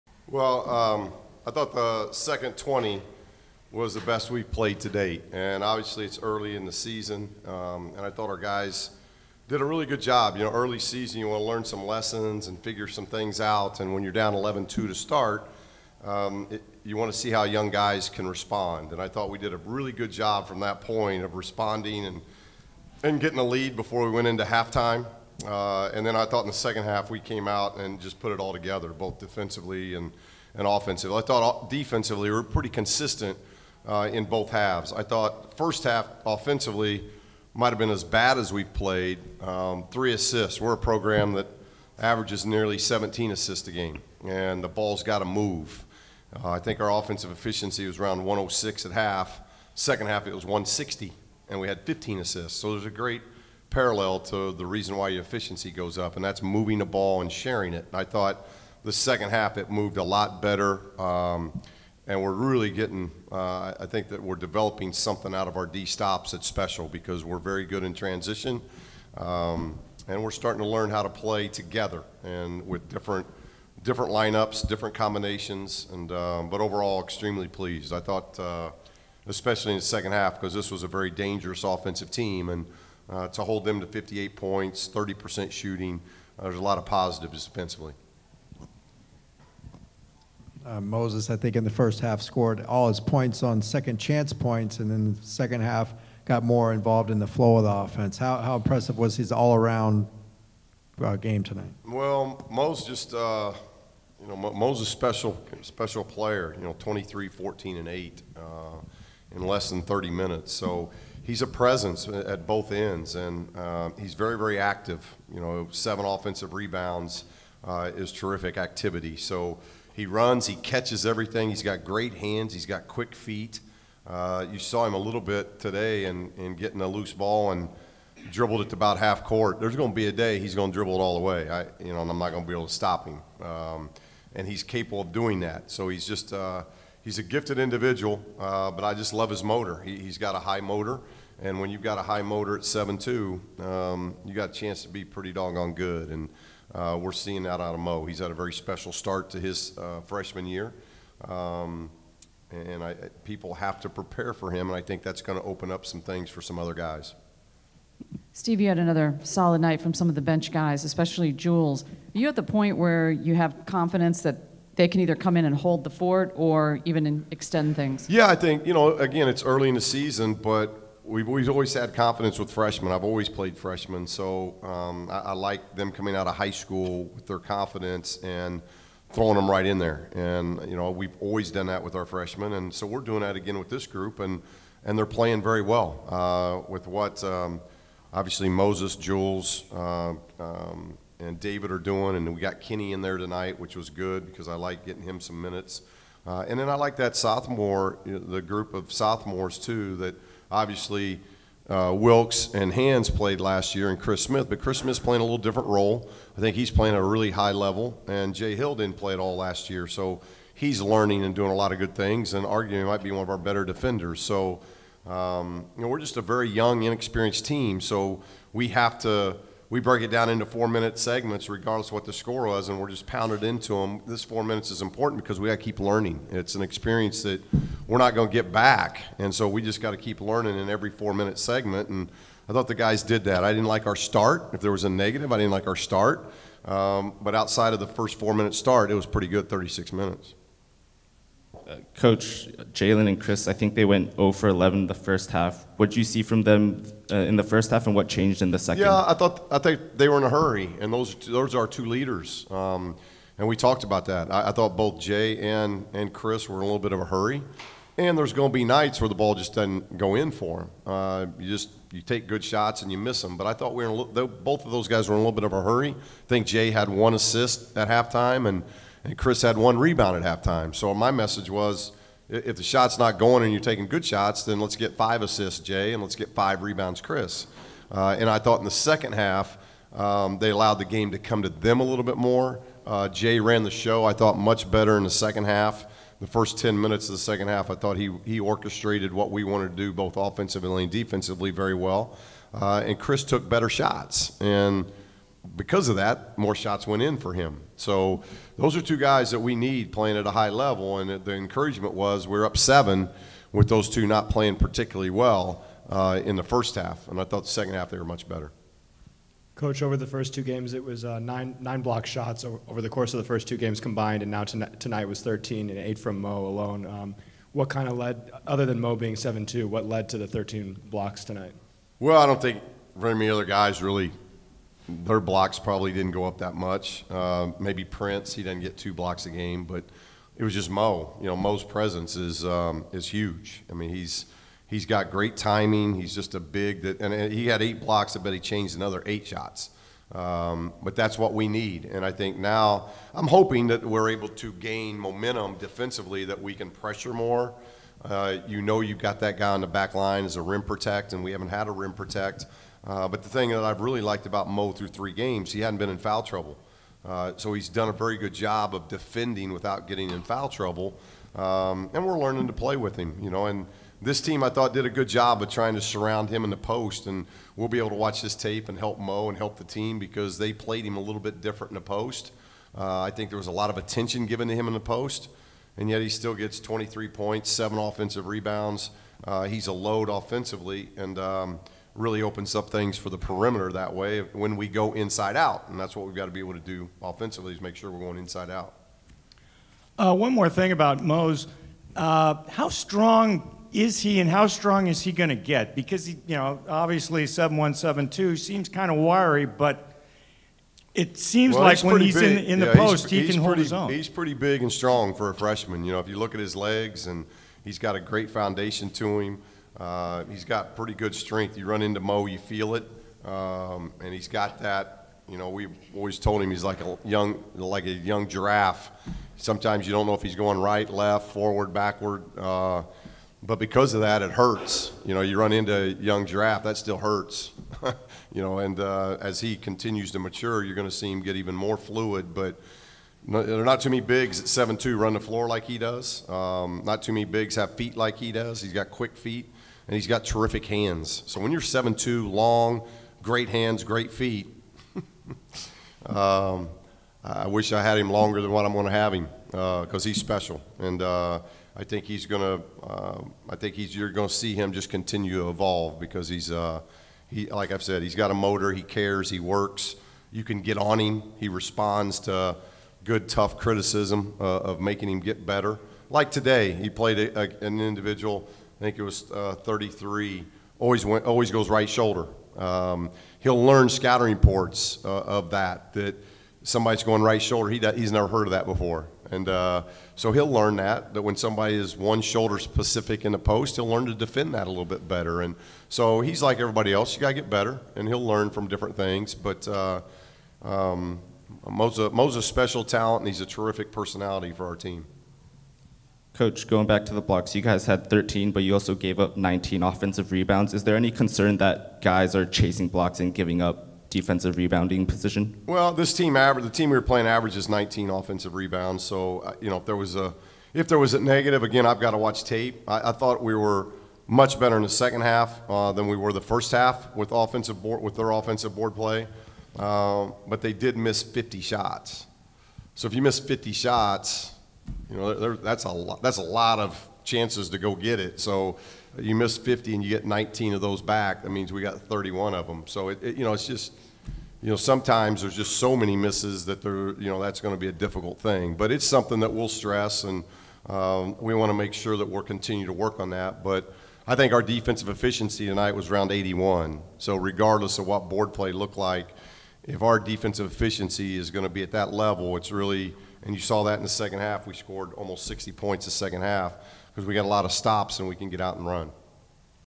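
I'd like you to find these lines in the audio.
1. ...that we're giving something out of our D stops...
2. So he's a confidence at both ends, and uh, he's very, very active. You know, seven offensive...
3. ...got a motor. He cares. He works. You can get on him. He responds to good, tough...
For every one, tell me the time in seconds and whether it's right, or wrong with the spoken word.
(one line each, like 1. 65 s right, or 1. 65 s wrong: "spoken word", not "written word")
1. 64 s wrong: "developing", not "giving"
2. 110 s wrong: "presence", not "confidence"
3. 458 s right.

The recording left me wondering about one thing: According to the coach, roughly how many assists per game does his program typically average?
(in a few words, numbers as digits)
nearly 17.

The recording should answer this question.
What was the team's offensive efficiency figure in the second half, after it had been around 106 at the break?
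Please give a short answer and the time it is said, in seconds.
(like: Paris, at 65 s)
160, at 50 s.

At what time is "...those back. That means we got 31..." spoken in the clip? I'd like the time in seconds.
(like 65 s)
530 s.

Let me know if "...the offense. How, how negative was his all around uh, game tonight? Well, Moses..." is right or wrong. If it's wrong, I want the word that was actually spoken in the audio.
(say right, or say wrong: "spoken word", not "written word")
wrong: "impressive", not "negative".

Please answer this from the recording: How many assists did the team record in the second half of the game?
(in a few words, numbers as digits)
15.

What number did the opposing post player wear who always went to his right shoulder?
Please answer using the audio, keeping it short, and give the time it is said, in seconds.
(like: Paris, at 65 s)
33, at 469 s.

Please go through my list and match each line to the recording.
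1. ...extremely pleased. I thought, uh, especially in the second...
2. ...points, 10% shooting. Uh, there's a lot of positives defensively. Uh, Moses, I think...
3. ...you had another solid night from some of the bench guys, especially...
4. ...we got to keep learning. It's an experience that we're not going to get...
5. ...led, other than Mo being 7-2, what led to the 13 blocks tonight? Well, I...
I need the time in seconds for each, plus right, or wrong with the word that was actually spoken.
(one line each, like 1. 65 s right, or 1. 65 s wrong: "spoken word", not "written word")
1. 77 s right
2. 84 s wrong: "30", not "10"
3. 158 s right
4. 225 s right
5. 317 s right.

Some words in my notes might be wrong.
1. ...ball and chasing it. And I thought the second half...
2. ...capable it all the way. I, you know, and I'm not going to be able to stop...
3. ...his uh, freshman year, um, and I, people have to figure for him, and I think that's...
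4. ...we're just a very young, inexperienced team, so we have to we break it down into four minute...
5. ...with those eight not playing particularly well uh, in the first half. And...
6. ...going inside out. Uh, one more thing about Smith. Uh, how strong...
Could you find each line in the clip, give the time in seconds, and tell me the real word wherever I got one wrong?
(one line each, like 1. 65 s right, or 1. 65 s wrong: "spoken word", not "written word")
1. 56 s wrong: "sharing", not "chasing"
2. 130 s wrong: "dribble", not "capable"
3. 149 s wrong: "prepare", not "figure"
4. 215 s right
5. 303 s wrong: "two", not "eight"
6. 387 s wrong: "Mose", not "Smith".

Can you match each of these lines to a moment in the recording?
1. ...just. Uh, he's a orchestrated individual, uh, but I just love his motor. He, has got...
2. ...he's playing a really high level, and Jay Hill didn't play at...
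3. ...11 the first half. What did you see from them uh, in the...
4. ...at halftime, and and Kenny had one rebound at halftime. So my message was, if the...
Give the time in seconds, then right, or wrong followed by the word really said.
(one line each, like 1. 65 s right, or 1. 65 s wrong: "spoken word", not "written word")
1. 136 s wrong: "gifted", not "orchestrated"
2. 206 s right
3. 244 s right
4. 267 s wrong: "Chris", not "Kenny".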